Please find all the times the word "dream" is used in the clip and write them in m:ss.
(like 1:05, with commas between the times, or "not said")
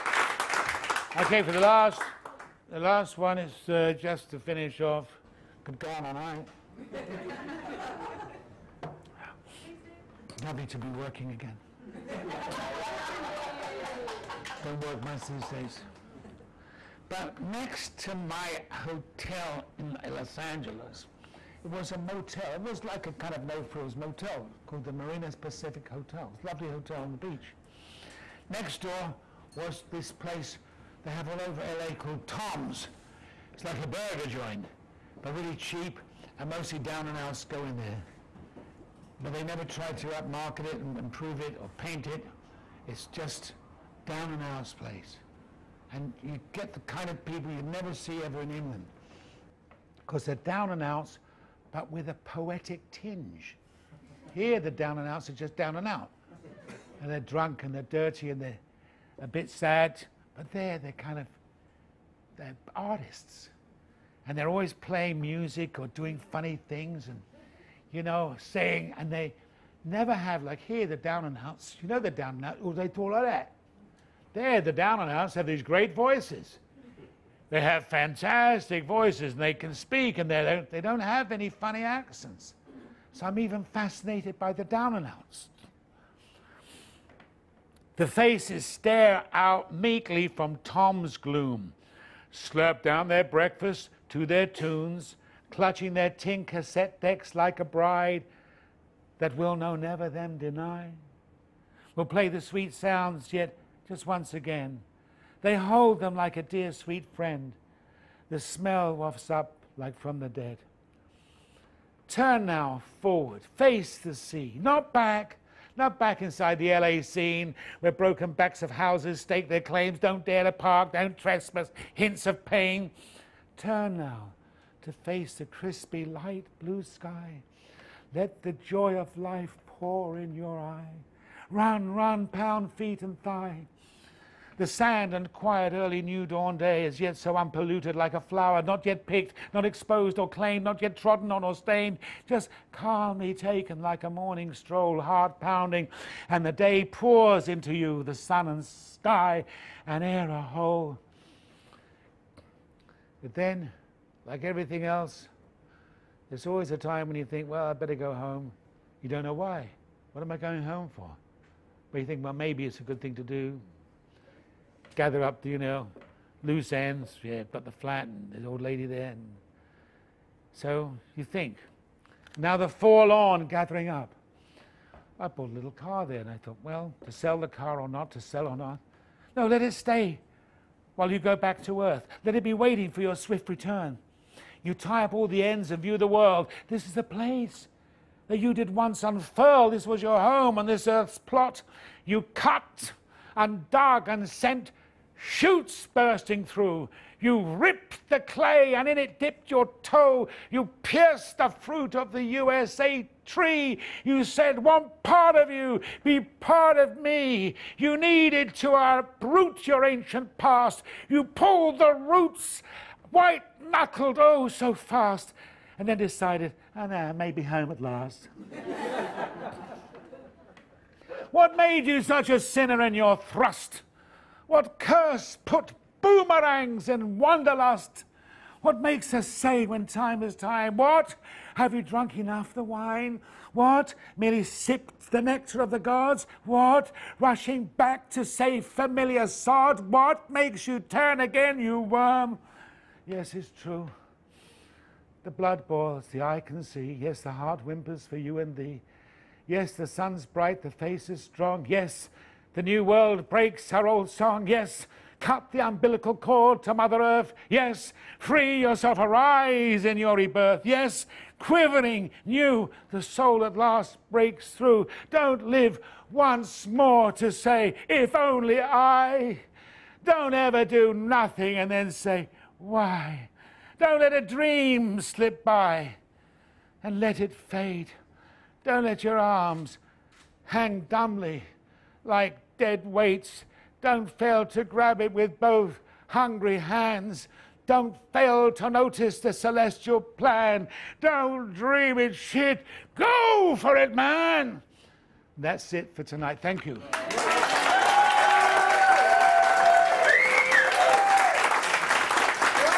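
4:34, 4:51.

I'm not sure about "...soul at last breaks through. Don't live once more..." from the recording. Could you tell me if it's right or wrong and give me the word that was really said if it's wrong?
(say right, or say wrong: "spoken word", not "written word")
right.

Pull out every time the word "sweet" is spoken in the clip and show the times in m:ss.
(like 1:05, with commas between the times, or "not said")
1:42, 1:46.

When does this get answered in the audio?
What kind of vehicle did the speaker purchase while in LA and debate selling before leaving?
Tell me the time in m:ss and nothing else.
2:55.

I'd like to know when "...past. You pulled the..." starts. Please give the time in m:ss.
3:30.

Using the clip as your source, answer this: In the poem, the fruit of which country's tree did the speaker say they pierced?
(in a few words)
USA.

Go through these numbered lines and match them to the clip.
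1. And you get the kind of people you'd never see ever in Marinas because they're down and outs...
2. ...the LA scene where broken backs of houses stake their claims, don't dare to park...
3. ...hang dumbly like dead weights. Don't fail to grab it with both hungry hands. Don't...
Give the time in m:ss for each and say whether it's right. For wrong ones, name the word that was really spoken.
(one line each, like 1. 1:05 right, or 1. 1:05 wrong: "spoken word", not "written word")
1. 0:45 wrong: "England", not "Marinas"
2. 1:56 right
3. 4:40 right.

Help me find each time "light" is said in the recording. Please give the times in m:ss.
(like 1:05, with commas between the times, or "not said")
2:06.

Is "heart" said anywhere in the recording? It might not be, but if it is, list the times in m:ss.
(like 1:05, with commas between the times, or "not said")
2:24, 4:07.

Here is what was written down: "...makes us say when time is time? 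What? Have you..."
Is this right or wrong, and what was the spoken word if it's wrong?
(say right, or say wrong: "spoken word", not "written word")
right.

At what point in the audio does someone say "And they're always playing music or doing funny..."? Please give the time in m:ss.
1:04.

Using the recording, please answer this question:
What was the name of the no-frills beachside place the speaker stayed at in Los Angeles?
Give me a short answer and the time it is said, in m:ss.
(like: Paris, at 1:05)
Marinas Pacific Hotel, at 0:24.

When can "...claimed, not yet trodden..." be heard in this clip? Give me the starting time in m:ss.
2:20.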